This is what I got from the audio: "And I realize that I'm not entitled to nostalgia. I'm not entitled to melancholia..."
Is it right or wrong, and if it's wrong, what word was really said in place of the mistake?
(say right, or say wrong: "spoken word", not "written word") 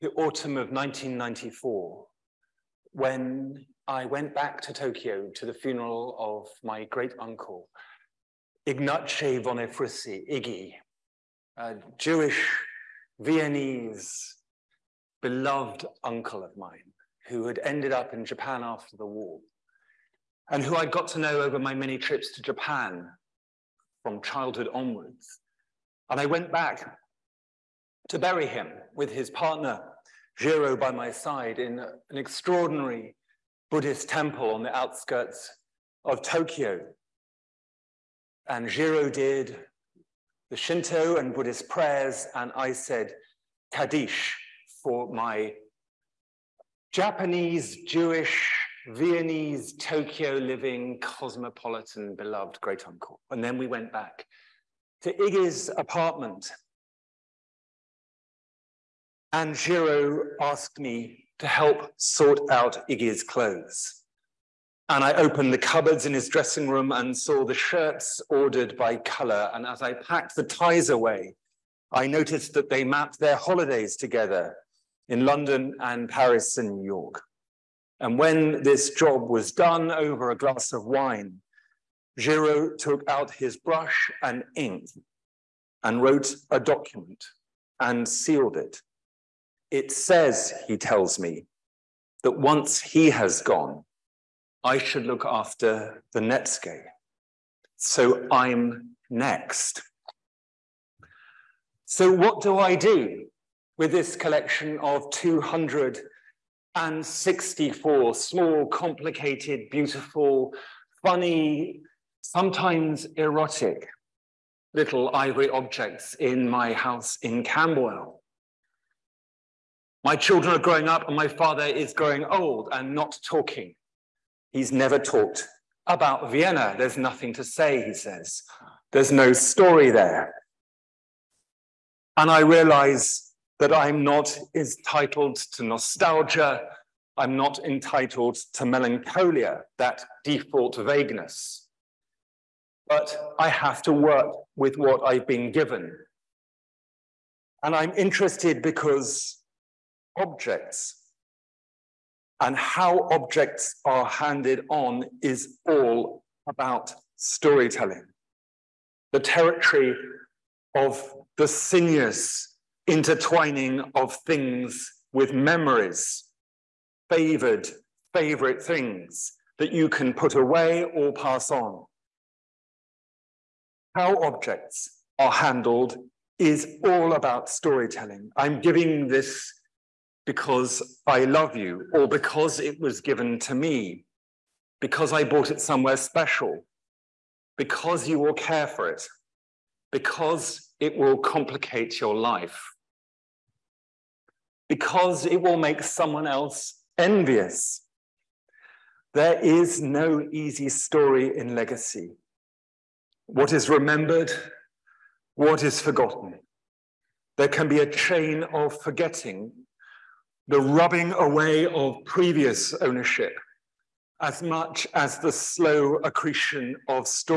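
right.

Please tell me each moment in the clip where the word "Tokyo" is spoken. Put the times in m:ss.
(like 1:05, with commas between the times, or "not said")
0:04, 0:36, 0:49.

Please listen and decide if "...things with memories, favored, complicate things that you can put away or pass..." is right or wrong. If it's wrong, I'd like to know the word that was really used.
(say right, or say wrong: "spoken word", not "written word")
wrong: "favorite", not "complicate".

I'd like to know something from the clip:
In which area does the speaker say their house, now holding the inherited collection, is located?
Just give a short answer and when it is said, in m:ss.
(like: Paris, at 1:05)
Camberwell, at 1:57.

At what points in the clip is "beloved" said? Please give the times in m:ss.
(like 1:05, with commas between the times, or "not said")
0:15, 0:52.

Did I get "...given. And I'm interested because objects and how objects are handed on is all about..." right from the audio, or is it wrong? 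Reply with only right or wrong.
right.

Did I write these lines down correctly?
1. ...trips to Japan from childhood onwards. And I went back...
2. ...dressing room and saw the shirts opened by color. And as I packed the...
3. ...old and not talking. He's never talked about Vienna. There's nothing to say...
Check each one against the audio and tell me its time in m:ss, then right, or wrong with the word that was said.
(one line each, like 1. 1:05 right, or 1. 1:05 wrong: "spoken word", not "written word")
1. 0:21 right
2. 1:06 wrong: "ordered", not "opened"
3. 2:02 right.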